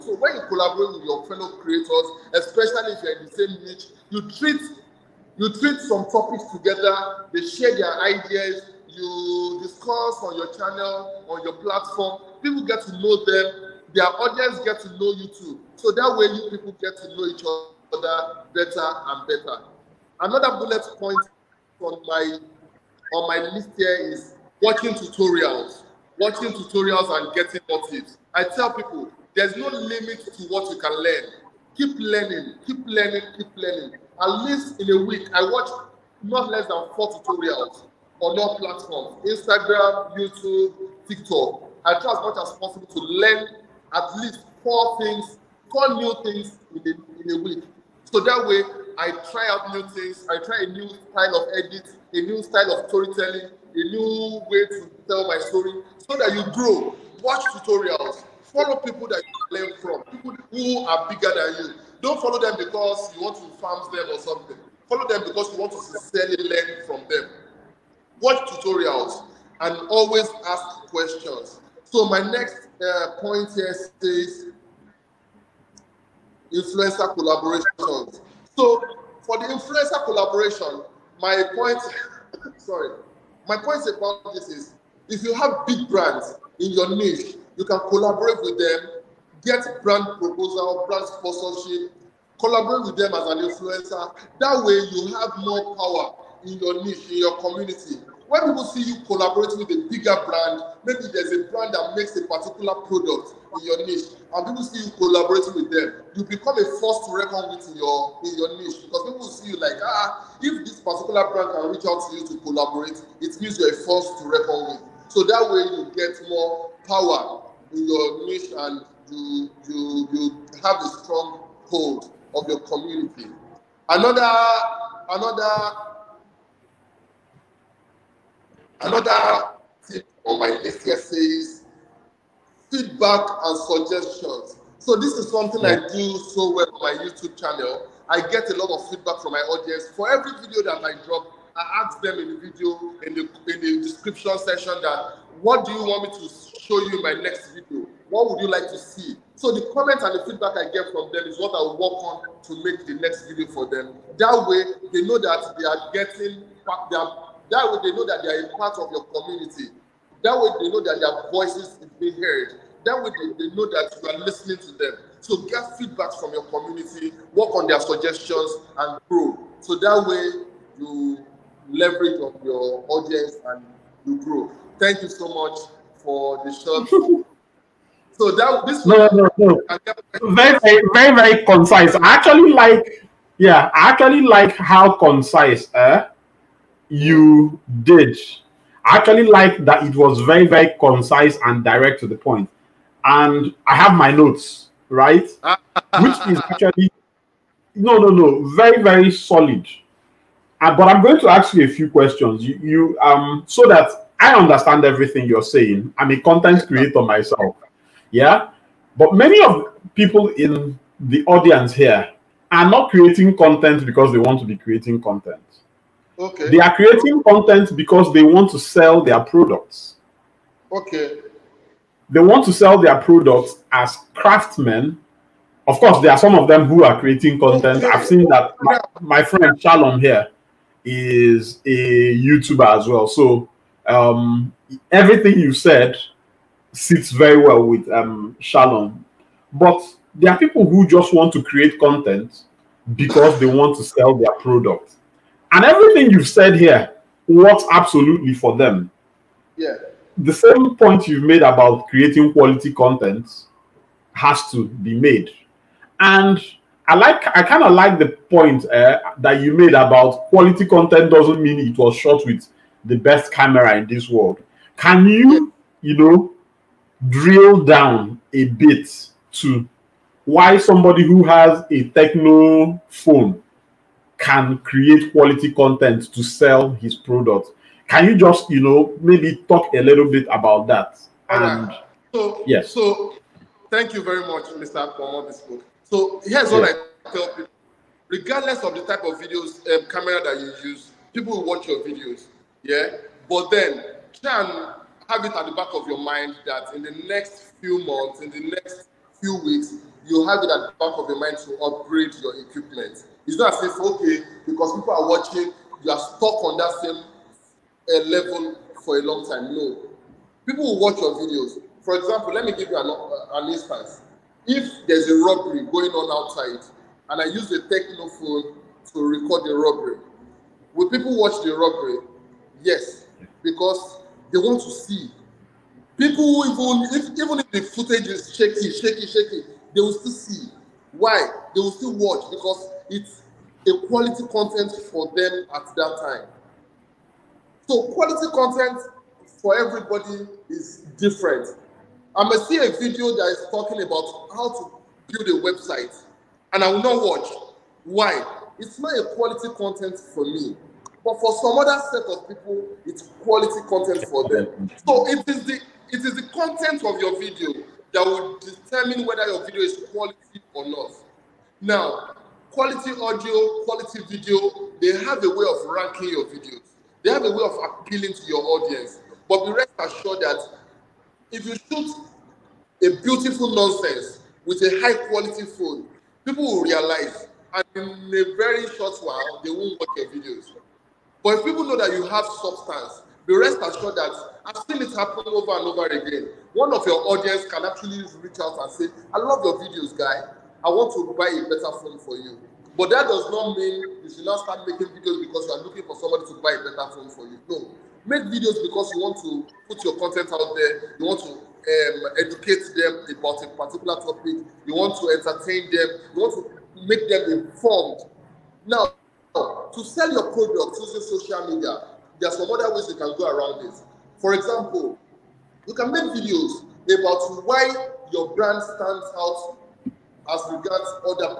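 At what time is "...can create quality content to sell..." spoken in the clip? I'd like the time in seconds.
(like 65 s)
274 s.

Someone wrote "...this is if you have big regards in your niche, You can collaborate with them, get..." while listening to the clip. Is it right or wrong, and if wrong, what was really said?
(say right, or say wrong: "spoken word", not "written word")
wrong: "brands", not "regards".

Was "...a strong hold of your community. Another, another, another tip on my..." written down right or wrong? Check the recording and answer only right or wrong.
right.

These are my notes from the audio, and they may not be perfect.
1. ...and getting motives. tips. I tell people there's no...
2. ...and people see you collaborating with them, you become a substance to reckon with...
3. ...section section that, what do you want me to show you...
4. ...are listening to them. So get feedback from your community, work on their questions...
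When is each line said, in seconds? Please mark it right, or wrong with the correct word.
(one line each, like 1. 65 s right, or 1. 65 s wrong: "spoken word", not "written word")
1. 27 s right
2. 104 s wrong: "force", not "substance"
3. 143 s wrong: "description", not "section"
4. 164 s wrong: "suggestions", not "questions".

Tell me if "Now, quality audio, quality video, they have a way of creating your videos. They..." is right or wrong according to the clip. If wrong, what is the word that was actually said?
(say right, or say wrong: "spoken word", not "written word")
wrong: "ranking", not "creating".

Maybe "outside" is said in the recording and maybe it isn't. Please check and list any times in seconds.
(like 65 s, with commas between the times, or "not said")
316 s.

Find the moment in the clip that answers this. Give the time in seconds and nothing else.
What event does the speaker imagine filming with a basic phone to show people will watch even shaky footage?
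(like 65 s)
315 s.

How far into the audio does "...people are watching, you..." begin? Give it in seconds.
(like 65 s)
304 s.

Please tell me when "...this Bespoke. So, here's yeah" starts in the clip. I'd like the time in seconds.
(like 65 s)
284 s.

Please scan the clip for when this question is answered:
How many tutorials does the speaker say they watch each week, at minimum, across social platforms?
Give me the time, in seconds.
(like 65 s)
36 s.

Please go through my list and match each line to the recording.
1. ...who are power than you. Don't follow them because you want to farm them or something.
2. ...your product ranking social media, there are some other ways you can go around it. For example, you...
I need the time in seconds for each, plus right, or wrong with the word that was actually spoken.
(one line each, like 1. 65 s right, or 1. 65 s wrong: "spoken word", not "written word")
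1. 60 s wrong: "bigger", not "power"
2. 410 s wrong: "using", not "ranking".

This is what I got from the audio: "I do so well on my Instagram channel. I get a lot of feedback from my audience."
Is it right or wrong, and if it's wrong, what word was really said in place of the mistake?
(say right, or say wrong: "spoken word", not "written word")
wrong: "YouTube", not "Instagram".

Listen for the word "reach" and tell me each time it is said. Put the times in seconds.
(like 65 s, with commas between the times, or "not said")
111 s, 388 s.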